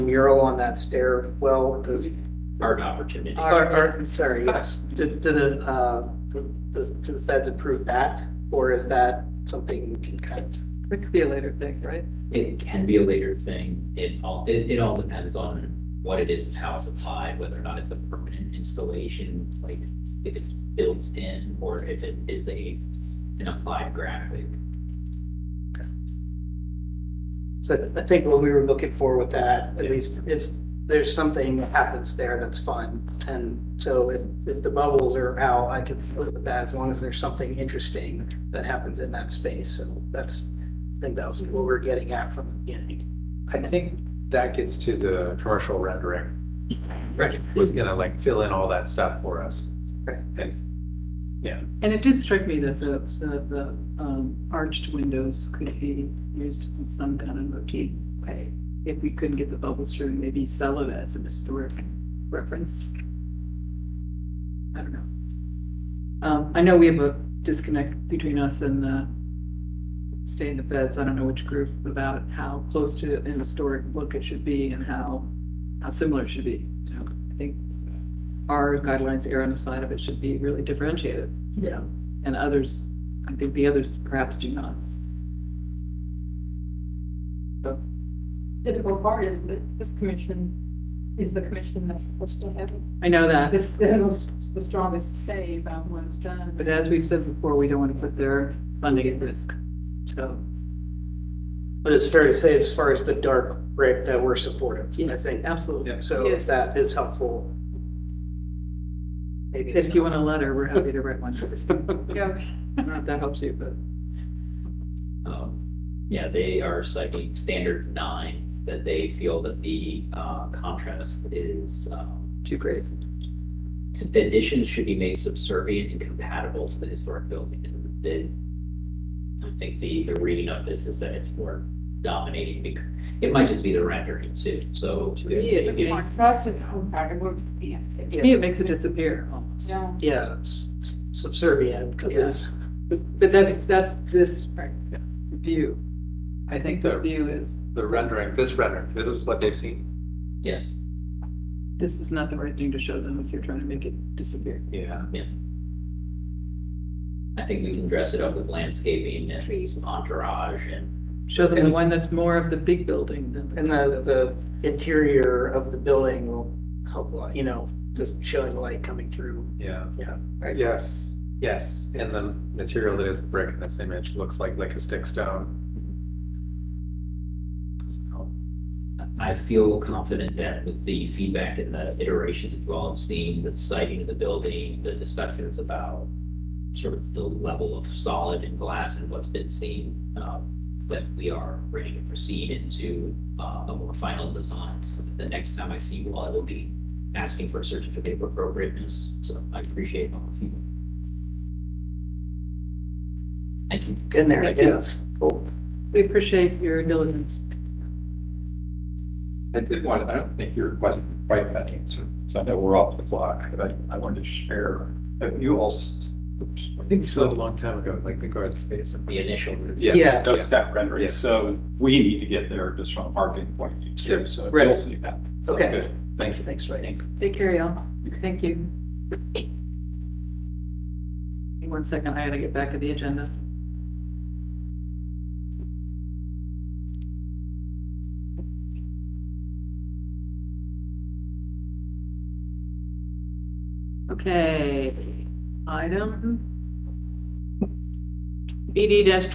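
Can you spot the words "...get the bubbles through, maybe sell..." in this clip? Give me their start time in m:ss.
0:59.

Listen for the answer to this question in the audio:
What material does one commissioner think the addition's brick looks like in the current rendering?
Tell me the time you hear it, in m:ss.
2:54.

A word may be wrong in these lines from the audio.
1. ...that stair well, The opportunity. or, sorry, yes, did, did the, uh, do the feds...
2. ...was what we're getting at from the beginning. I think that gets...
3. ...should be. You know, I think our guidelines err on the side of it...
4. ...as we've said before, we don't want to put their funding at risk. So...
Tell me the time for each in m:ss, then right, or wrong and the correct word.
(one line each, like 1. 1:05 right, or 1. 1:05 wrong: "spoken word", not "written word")
1. 0:00 wrong: "Art", not "The"
2. 0:41 right
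3. 1:16 right
4. 1:36 right.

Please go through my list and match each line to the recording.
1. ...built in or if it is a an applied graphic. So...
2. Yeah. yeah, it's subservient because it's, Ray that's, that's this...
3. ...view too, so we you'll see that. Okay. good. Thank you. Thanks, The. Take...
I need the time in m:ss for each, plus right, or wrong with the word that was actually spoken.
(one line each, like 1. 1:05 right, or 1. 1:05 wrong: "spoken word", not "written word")
1. 0:20 right
2. 2:19 wrong: "But", not "Ray"
3. 3:43 wrong: "Ray", not "The".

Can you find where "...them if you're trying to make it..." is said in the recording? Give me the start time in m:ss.
2:33.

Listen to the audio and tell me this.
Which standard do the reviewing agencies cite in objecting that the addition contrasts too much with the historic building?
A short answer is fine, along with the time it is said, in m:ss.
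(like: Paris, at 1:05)
Standard nine, at 1:57.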